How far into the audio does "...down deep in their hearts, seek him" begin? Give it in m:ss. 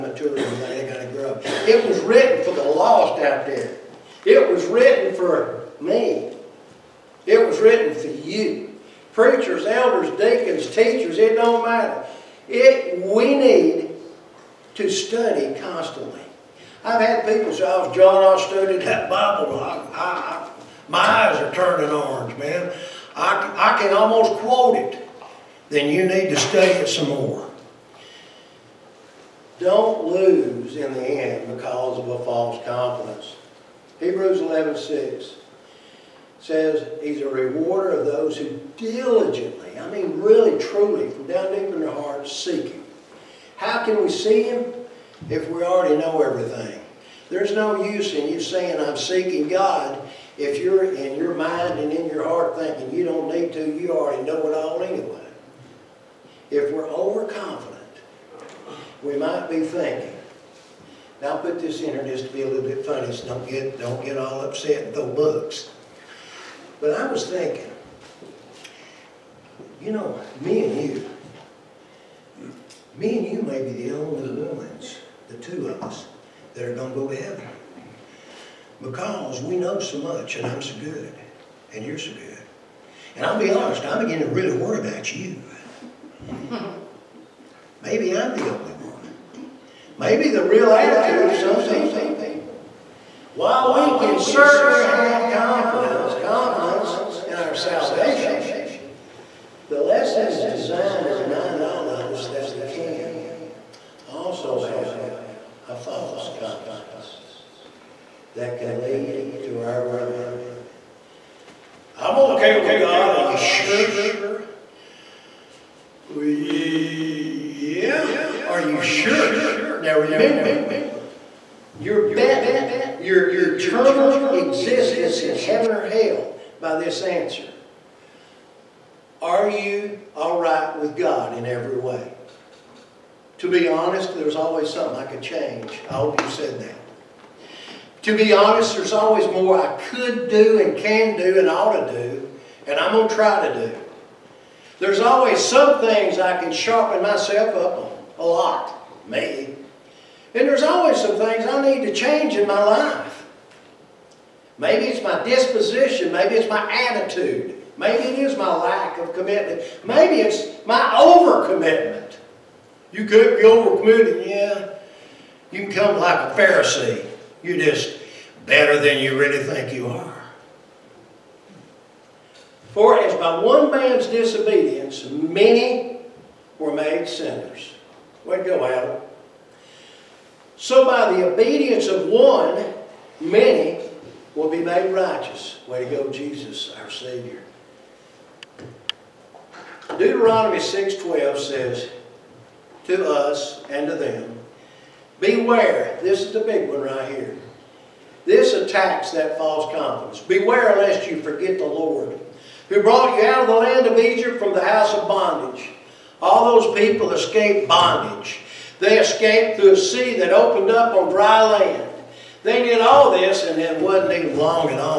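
0:41.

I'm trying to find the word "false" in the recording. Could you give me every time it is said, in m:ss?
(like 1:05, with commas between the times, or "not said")
0:32, 1:45, 3:19.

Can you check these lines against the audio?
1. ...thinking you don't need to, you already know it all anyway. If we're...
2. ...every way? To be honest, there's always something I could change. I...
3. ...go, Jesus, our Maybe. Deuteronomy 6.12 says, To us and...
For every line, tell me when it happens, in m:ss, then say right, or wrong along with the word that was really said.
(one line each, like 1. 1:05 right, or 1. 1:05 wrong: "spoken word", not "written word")
1. 0:52 right
2. 2:11 right
3. 3:05 wrong: "Savior", not "Maybe".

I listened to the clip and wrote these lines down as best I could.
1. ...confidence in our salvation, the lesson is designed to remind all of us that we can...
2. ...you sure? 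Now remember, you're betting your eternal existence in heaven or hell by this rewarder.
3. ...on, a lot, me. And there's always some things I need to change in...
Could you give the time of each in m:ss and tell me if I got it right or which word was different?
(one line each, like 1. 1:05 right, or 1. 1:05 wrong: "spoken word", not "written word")
1. 1:36 right
2. 1:58 wrong: "answer", not "rewarder"
3. 2:27 right.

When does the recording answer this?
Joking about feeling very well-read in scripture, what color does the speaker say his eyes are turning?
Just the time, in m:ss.
0:21.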